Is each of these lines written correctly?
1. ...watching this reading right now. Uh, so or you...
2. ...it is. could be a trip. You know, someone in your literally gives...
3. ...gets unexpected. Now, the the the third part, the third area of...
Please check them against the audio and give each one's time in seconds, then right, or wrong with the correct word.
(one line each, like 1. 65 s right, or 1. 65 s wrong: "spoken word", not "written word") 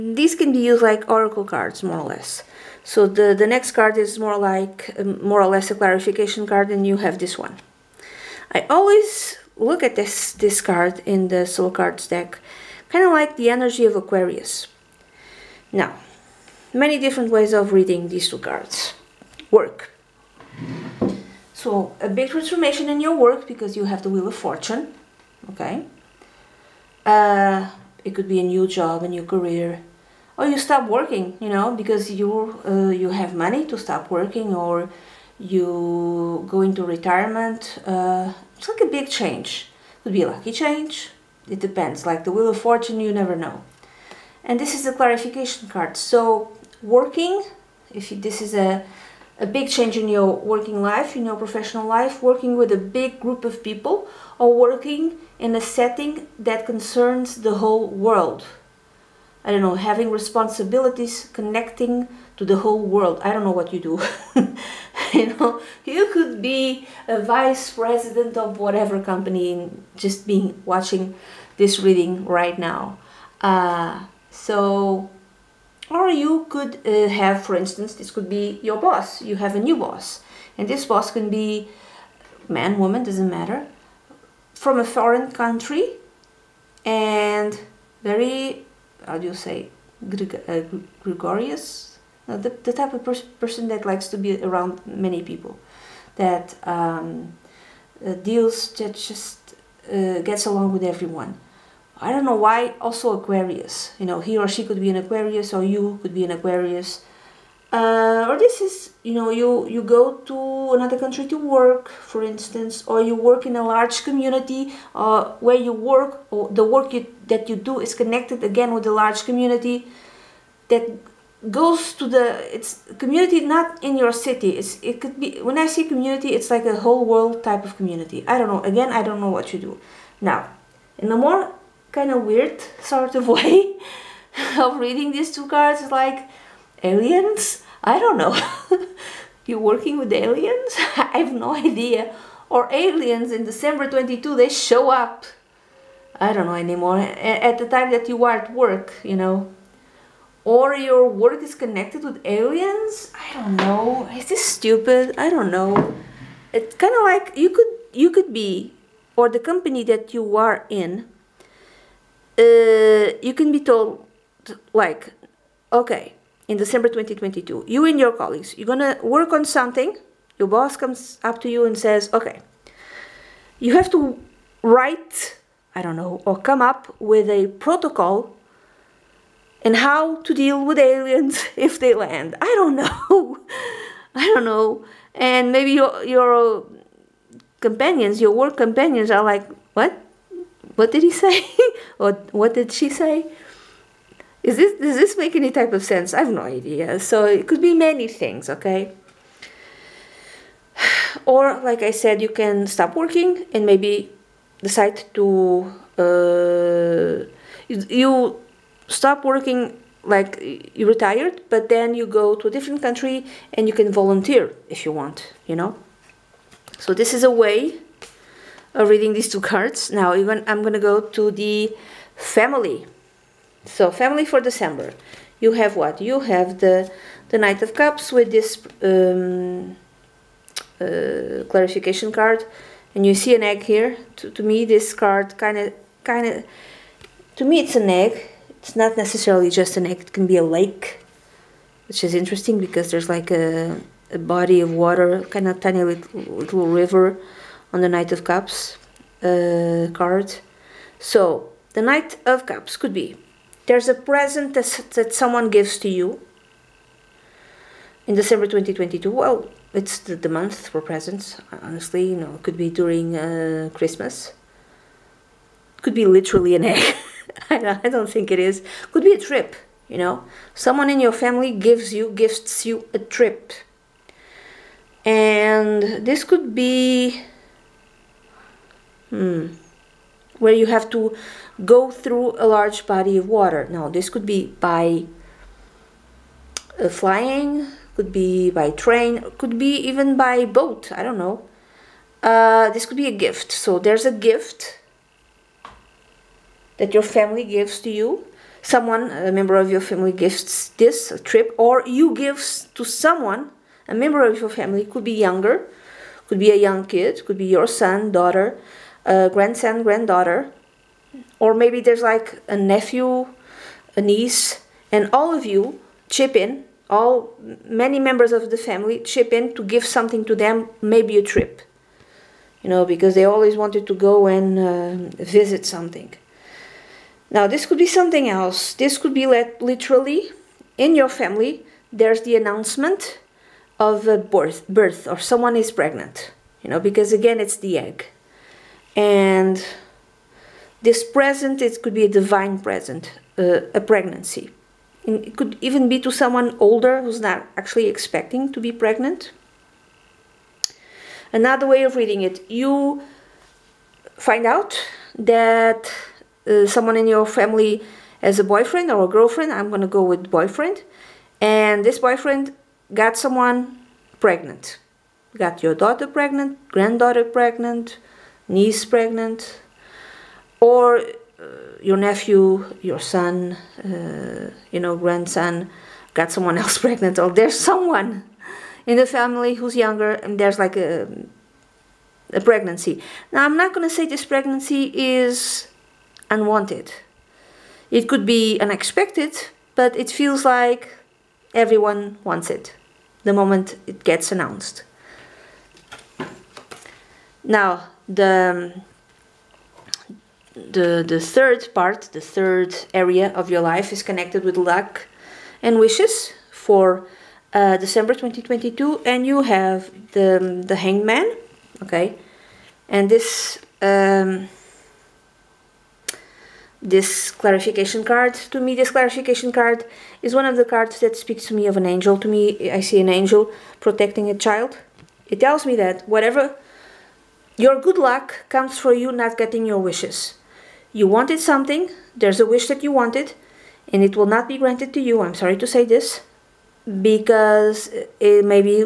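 1. 70 s right
2. 268 s wrong: "family", not "literally"
3. 394 s wrong: "announced", not "unexpected".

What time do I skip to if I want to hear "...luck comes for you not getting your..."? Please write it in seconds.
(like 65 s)
427 s.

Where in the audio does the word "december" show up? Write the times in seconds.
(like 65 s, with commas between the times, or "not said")
143 s, 166 s, 224 s, 258 s, 407 s.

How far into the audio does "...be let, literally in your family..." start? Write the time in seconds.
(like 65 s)
329 s.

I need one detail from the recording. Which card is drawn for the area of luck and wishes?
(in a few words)
The Hangman.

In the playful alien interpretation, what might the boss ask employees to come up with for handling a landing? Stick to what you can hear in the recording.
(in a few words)
A protocol.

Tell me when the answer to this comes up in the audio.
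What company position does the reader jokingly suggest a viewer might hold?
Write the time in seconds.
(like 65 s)
67 s.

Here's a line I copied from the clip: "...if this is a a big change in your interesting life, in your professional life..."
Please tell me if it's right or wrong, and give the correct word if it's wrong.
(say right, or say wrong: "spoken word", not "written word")
wrong: "working", not "interesting".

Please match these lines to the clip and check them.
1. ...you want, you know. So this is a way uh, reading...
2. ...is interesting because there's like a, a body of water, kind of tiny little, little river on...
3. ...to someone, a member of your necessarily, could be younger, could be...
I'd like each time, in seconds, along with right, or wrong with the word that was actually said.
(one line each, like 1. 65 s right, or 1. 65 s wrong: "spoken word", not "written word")
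1. 214 s right
2. 242 s right
3. 302 s wrong: "family", not "necessarily".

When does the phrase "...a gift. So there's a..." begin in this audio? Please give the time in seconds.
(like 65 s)
293 s.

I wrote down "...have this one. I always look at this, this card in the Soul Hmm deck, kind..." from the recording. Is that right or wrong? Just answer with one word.
wrong.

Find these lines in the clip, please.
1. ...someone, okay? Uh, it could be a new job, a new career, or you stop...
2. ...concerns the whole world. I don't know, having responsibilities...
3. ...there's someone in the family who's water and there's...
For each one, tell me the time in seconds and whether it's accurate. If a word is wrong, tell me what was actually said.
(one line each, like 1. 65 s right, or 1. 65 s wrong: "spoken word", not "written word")
1. 24 s wrong: "fortune", not "someone"
2. 56 s right
3. 377 s wrong: "younger", not "water".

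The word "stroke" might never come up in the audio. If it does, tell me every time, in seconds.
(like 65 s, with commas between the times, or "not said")
not said.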